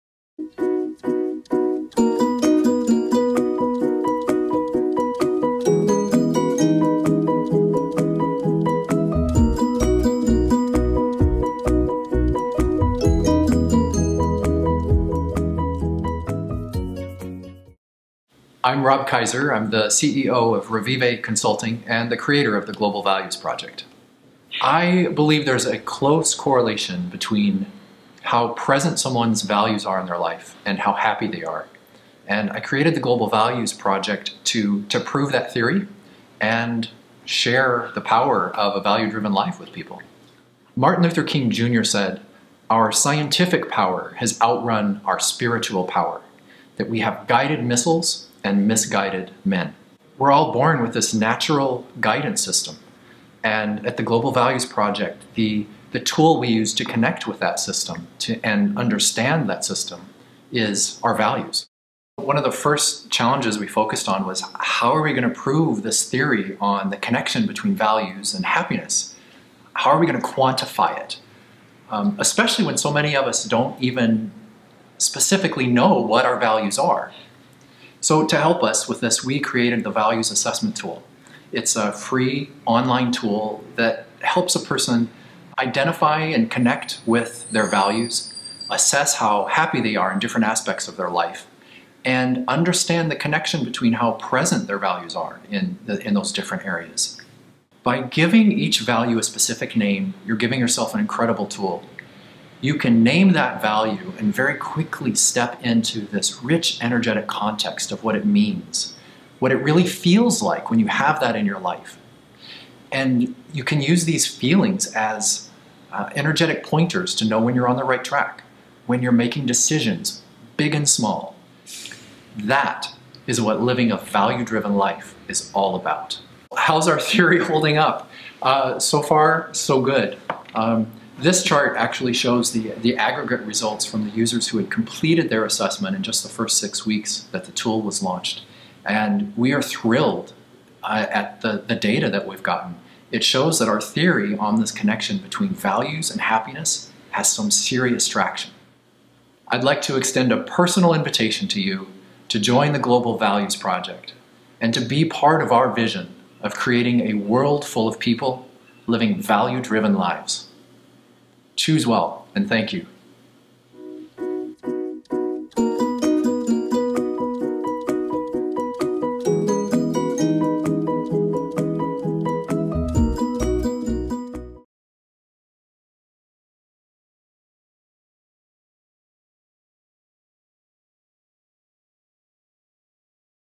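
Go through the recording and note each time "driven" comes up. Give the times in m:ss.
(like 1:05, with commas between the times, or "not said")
0:39, 2:04, 2:39.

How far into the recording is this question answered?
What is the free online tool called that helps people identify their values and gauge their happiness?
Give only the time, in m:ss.
1:19.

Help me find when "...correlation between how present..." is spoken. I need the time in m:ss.
0:26.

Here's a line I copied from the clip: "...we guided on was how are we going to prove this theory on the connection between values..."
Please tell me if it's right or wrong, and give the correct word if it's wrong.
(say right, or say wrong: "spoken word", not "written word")
wrong: "focused", not "guided".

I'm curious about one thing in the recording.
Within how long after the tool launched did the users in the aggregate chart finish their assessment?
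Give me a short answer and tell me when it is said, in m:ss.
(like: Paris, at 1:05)
6 weeks, at 2:16.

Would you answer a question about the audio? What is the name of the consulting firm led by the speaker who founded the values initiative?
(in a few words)
Revivae Consulting.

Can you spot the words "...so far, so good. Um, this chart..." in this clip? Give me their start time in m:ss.
2:08.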